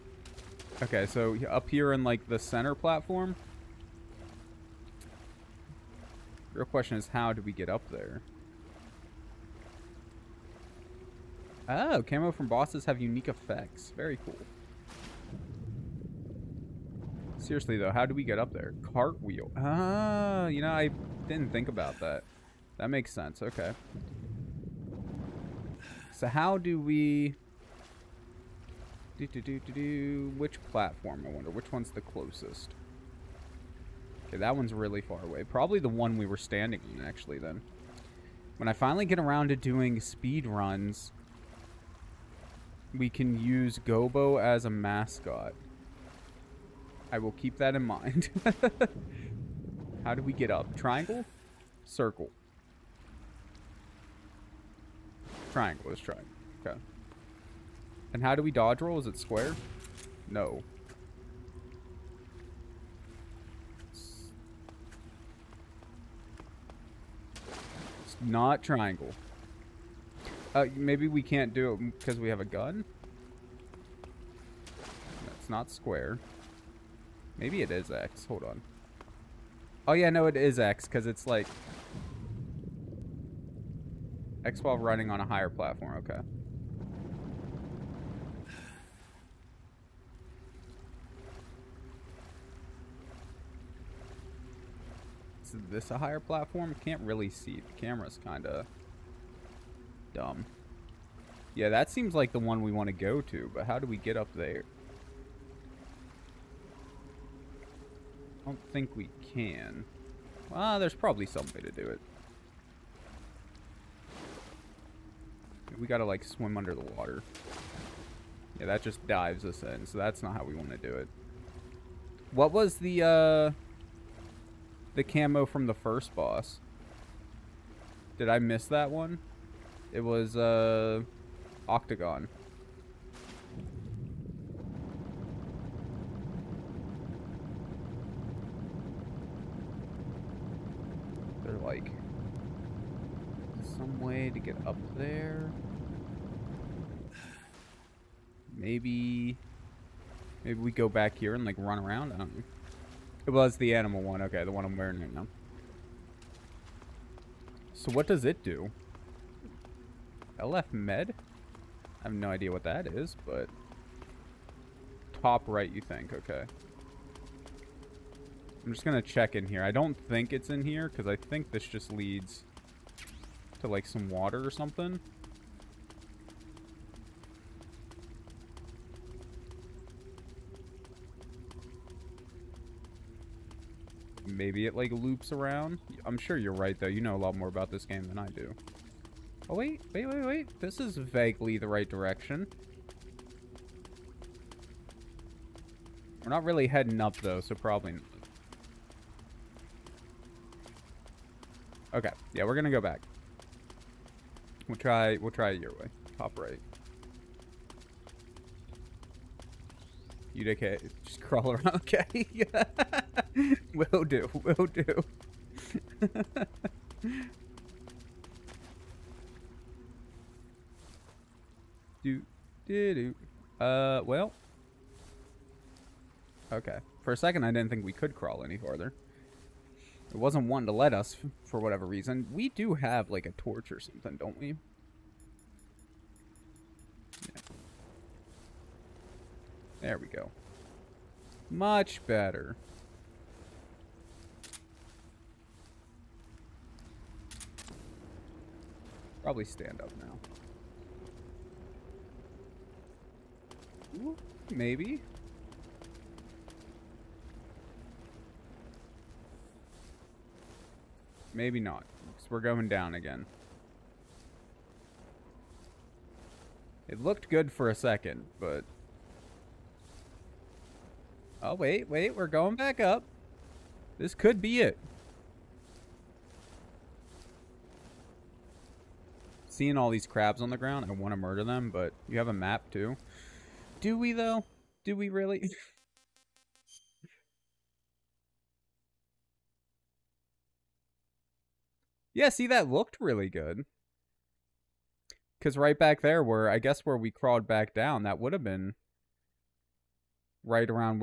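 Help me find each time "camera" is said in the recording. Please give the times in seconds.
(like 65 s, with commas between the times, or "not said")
97 s.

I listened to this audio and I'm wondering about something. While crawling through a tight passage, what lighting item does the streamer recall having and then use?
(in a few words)
A torch.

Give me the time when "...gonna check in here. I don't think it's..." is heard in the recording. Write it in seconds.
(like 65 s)
168 s.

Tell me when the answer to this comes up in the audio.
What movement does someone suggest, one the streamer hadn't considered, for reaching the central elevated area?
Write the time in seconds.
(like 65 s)
18 s.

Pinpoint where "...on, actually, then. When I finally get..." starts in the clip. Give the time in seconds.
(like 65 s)
36 s.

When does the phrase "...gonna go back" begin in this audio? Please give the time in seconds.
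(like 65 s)
202 s.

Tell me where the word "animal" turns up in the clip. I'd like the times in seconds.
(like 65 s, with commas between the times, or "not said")
153 s.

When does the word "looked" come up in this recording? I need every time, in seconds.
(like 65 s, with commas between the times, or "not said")
267 s, 292 s.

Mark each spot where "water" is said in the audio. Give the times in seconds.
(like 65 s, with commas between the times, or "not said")
116 s, 174 s.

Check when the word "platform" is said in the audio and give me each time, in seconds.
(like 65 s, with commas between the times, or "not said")
2 s, 30 s, 85 s, 96 s.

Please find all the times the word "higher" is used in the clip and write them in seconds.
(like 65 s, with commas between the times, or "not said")
85 s, 95 s.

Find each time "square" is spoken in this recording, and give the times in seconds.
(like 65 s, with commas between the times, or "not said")
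59 s, 75 s.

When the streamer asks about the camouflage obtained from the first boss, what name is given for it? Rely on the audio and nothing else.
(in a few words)
Octagon.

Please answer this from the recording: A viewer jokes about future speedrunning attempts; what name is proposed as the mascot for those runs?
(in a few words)
Gobo.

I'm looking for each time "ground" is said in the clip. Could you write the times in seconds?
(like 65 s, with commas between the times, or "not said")
280 s.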